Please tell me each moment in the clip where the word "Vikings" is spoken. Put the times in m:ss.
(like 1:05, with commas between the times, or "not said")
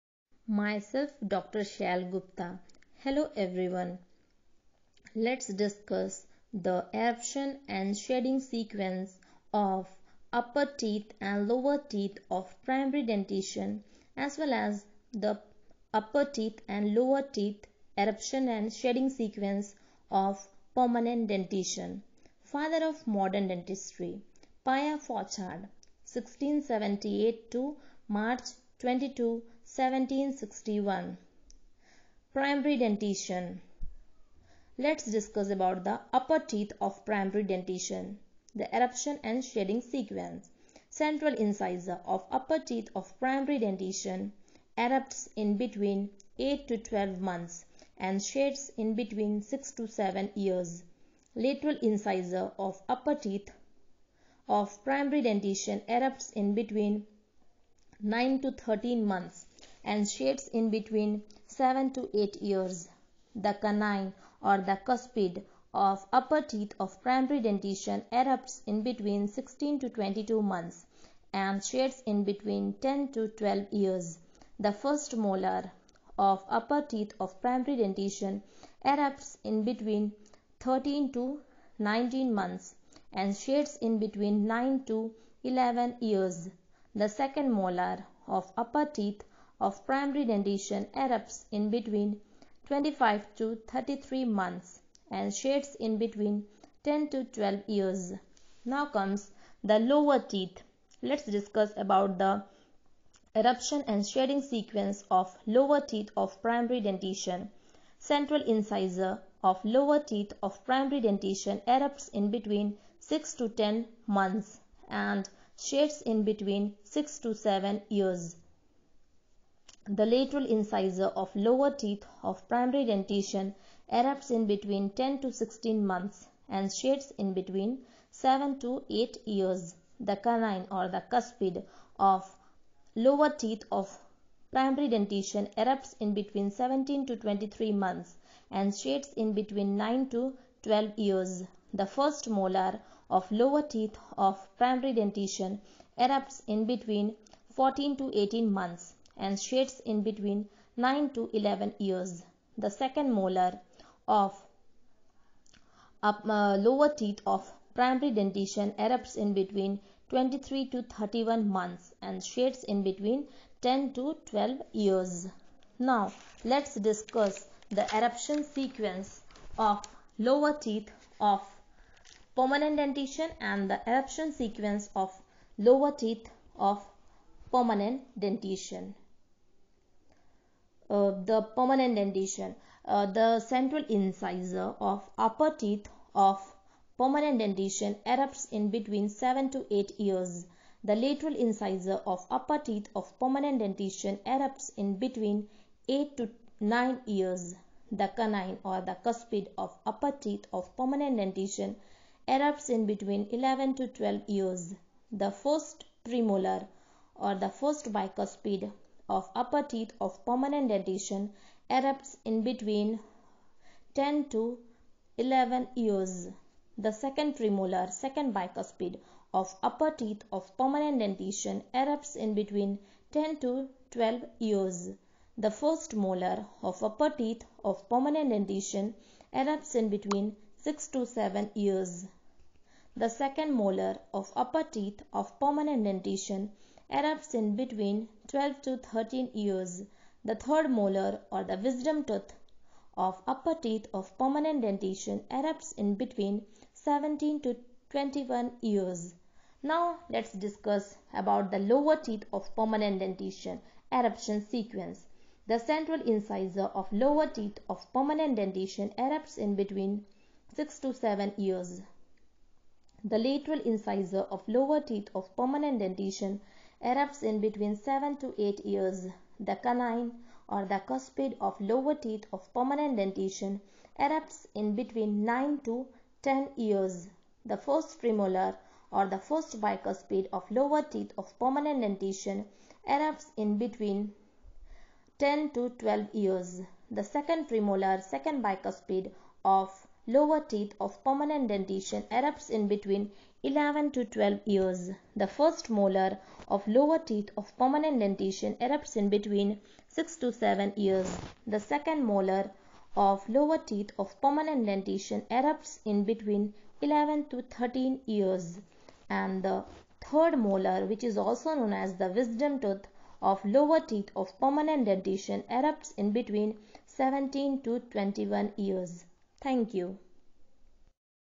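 not said.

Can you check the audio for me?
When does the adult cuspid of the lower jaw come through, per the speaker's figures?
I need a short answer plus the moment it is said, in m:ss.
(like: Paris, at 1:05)
9 to 10 years, at 4:35.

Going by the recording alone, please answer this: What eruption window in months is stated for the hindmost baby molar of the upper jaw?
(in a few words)
25 to 33 months.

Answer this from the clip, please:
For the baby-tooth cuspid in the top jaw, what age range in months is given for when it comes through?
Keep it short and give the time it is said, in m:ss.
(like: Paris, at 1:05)
16 to 22 months, at 1:09.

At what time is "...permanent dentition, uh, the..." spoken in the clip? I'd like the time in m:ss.
3:01.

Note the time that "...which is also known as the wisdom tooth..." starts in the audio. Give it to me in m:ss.
5:10.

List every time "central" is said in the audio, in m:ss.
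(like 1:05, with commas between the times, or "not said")
0:40, 1:47, 3:03, 4:15.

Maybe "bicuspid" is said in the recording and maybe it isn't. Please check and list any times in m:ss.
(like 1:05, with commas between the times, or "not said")
3:27, 3:38, 4:39, 4:48.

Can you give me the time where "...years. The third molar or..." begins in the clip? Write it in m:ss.
3:59.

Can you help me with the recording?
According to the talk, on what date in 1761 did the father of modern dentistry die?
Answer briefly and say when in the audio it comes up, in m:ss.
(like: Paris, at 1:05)
March 22, at 0:28.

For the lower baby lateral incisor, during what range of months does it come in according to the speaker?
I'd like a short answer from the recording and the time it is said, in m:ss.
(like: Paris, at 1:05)
10 to 16 months, at 2:04.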